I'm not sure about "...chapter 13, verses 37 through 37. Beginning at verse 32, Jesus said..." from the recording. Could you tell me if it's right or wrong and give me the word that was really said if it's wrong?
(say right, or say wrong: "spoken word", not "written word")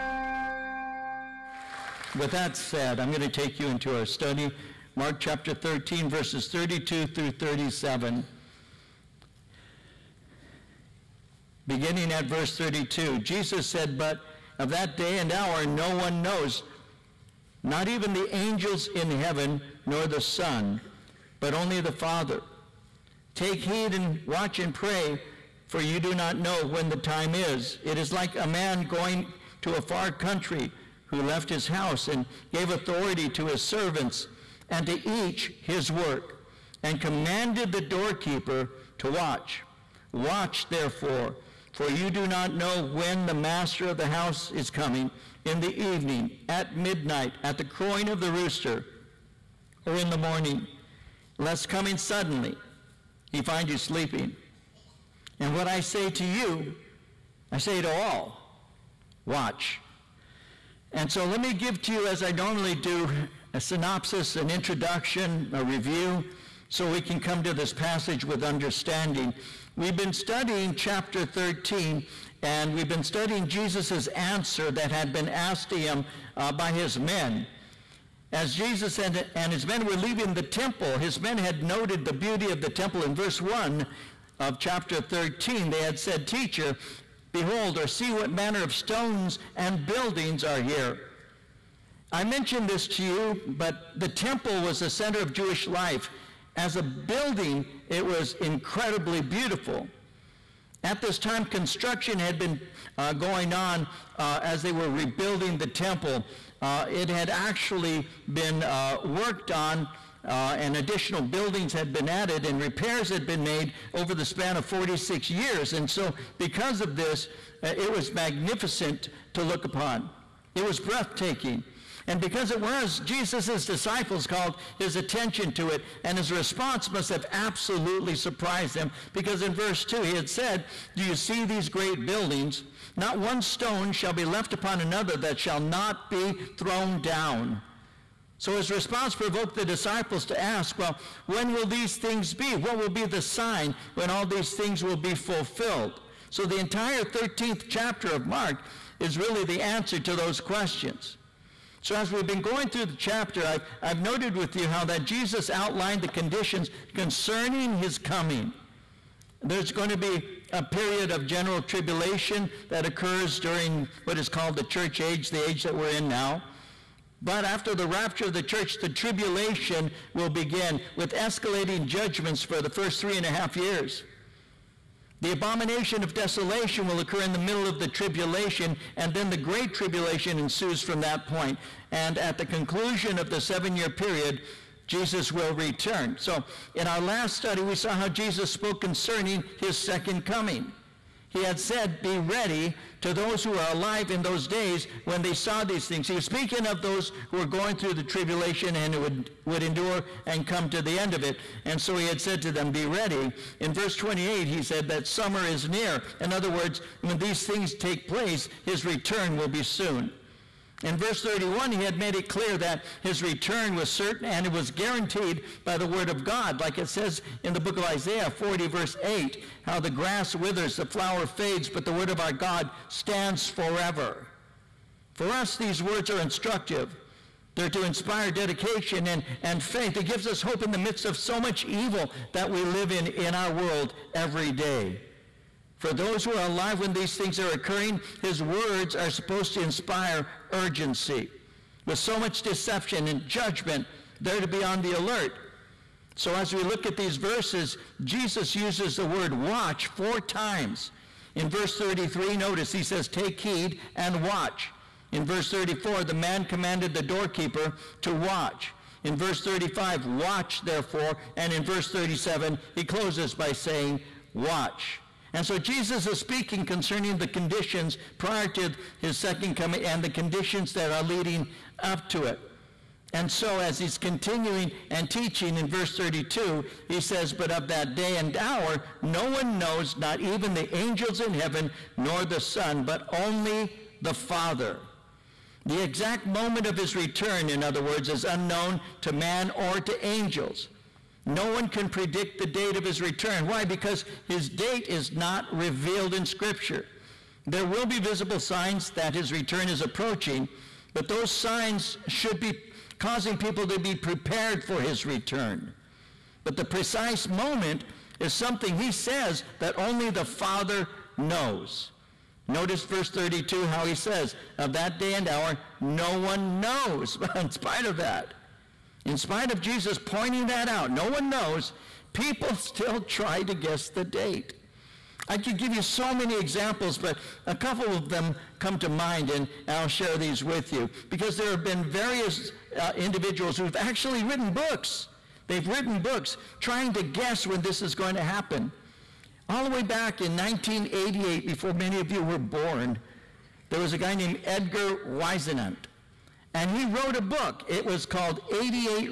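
wrong: "32", not "37".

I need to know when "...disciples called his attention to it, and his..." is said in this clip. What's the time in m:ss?
2:03.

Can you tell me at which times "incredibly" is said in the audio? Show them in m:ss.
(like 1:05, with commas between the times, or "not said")
1:38.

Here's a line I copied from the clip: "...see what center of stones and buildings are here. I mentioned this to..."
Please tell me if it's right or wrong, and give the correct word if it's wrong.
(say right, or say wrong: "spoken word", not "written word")
wrong: "manner", not "center".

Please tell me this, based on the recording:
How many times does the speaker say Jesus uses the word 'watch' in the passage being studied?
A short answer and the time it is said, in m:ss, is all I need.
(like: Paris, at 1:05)
4, at 4:09.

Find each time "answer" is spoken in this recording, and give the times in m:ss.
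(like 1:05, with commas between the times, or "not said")
1:14, 2:29.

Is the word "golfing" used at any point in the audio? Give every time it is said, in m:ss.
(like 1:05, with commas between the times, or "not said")
not said.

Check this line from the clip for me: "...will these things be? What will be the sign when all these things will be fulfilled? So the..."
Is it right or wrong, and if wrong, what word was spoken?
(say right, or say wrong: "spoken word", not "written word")
right.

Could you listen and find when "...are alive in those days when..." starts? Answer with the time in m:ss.
3:13.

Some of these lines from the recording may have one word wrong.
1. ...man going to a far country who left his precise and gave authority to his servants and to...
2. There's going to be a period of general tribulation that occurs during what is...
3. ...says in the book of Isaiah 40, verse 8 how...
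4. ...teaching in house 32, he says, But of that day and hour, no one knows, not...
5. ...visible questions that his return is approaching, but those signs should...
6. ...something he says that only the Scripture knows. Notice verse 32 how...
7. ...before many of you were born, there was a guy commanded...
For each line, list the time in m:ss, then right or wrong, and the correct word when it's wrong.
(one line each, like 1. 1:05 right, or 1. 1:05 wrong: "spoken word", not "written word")
1. 0:28 wrong: "house", not "precise"
2. 2:39 right
3. 3:36 right
4. 4:35 wrong: "verse", not "house"
5. 4:57 wrong: "signs", not "questions"
6. 5:08 wrong: "Father", not "Scripture"
7. 5:41 wrong: "named", not "commanded".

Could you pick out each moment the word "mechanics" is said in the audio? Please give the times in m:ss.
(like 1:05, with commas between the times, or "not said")
not said.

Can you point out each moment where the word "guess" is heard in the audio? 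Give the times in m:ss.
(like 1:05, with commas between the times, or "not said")
5:23, 5:37.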